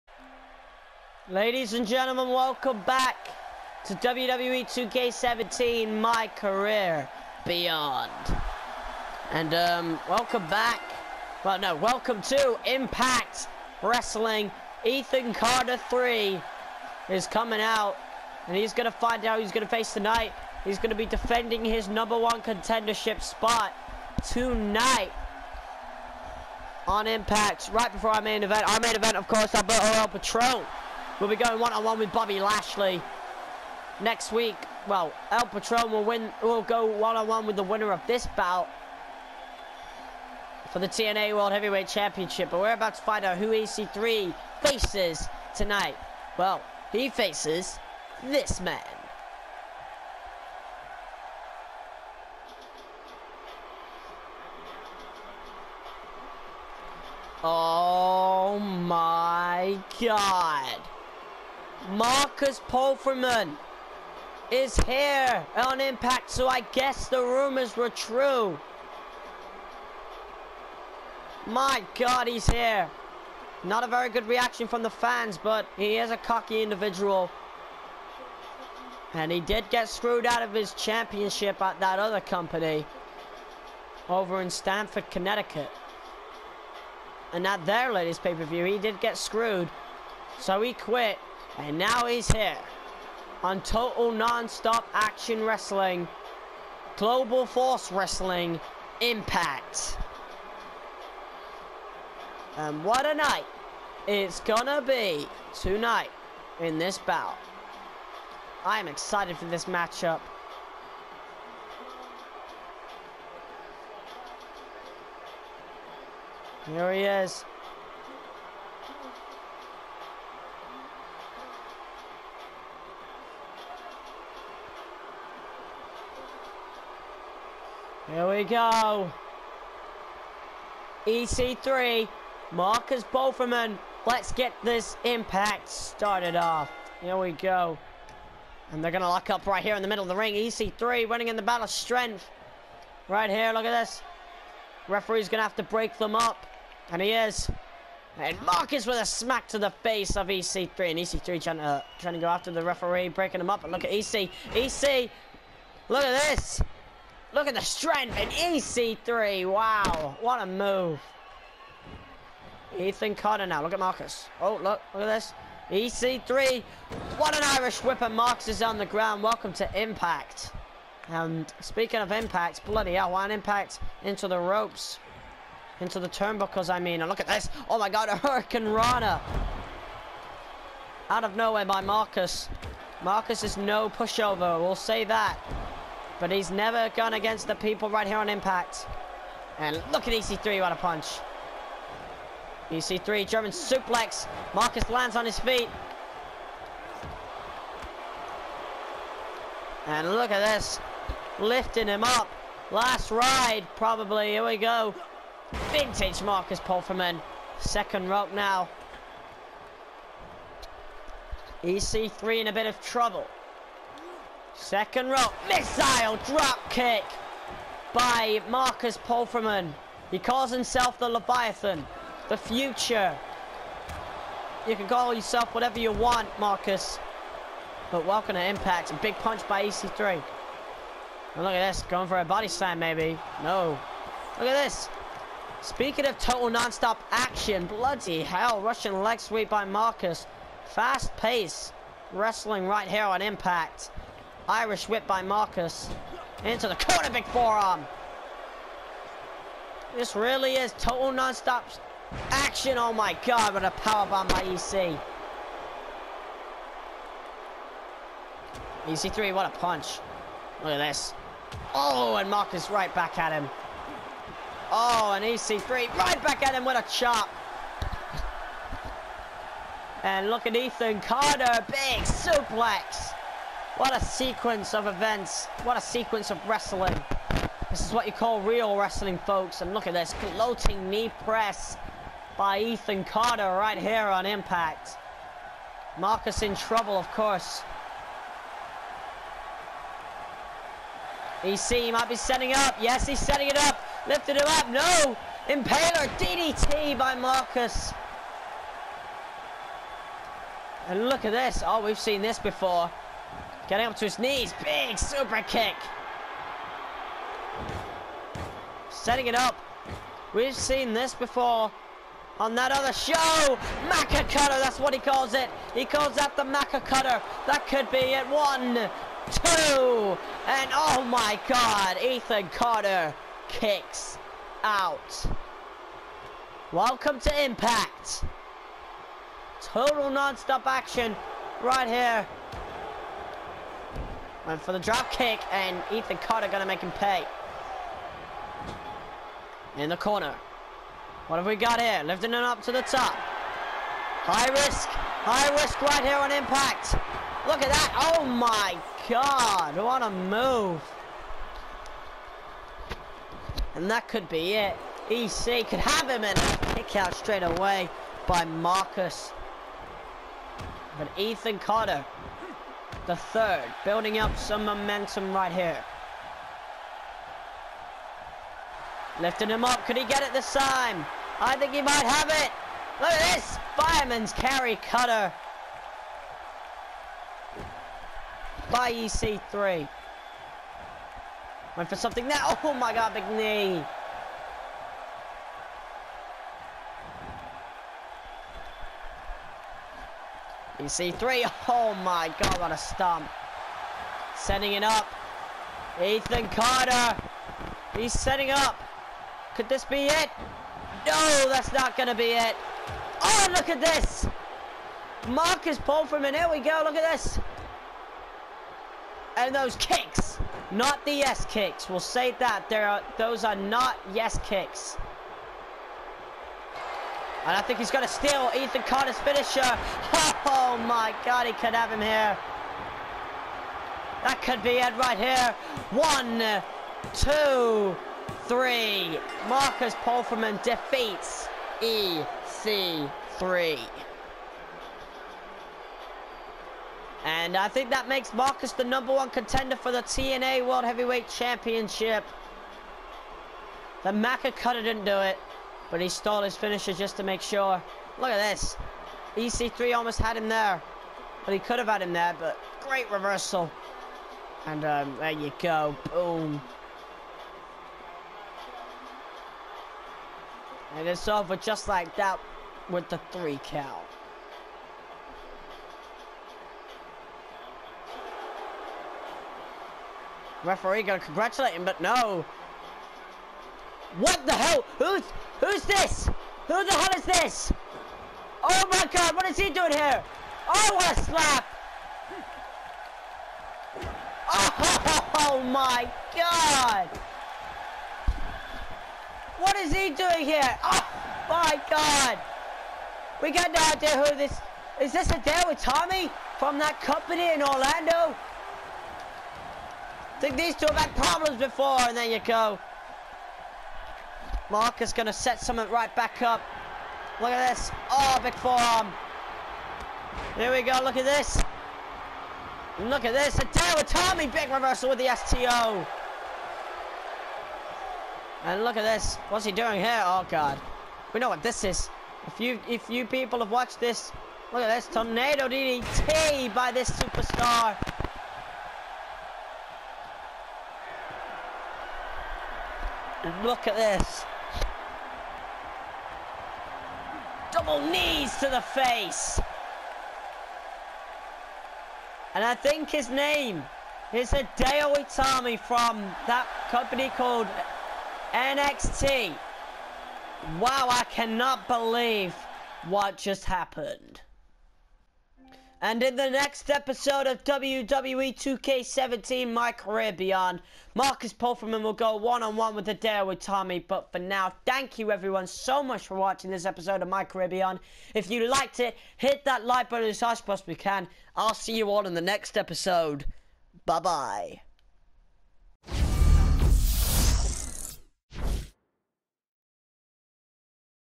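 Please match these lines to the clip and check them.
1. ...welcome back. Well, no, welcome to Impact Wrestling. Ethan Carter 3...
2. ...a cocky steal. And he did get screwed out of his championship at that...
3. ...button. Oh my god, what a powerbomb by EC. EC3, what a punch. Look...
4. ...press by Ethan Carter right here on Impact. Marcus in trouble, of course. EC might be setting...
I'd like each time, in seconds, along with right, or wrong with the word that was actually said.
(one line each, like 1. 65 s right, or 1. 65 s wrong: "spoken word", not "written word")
1. 10 s right
2. 76 s wrong: "individual", not "steal"
3. 252 s wrong: "action", not "button"
4. 281 s right.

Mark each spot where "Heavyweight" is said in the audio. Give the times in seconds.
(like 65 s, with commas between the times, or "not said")
41 s, 440 s.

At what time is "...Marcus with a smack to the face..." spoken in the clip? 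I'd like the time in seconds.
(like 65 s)
148 s.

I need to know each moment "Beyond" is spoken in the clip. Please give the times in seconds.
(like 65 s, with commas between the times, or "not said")
7 s, 560 s, 567 s.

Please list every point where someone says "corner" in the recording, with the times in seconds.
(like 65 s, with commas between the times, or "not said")
246 s, 339 s.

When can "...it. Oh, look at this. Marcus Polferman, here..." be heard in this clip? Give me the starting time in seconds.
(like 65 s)
402 s.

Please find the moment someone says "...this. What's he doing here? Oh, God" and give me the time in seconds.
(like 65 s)
519 s.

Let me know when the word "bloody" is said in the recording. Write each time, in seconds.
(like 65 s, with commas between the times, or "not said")
172 s, 237 s.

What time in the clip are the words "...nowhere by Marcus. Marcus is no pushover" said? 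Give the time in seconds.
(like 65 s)
181 s.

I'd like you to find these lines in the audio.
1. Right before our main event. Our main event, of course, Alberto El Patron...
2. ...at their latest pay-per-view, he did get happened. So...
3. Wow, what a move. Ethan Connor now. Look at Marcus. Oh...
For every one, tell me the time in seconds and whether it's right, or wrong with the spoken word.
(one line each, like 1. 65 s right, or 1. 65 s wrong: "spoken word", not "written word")
1. 27 s right
2. 87 s wrong: "screwed", not "happened"
3. 159 s right.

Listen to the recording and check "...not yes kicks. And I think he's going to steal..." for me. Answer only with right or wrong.
right.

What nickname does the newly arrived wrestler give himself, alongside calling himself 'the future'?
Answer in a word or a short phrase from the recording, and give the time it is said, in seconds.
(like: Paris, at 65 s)
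the Leviathan, at 220 s.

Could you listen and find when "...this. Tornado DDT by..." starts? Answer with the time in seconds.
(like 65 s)
524 s.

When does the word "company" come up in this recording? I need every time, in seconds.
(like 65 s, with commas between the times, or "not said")
82 s, 497 s, 546 s.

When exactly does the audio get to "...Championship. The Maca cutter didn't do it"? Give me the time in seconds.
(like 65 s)
441 s.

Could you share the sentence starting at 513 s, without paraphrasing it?
Hideo Itami big reversal with the STO.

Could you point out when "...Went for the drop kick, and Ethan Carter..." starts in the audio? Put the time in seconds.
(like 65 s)
334 s.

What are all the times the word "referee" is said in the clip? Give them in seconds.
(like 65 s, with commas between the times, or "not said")
144 s, 152 s, 470 s.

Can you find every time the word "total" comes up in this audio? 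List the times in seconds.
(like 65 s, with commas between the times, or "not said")
93 s, 236 s, 250 s, 329 s.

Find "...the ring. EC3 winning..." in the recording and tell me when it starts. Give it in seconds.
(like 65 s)
140 s.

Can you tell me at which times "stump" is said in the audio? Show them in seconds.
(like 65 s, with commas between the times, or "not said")
392 s.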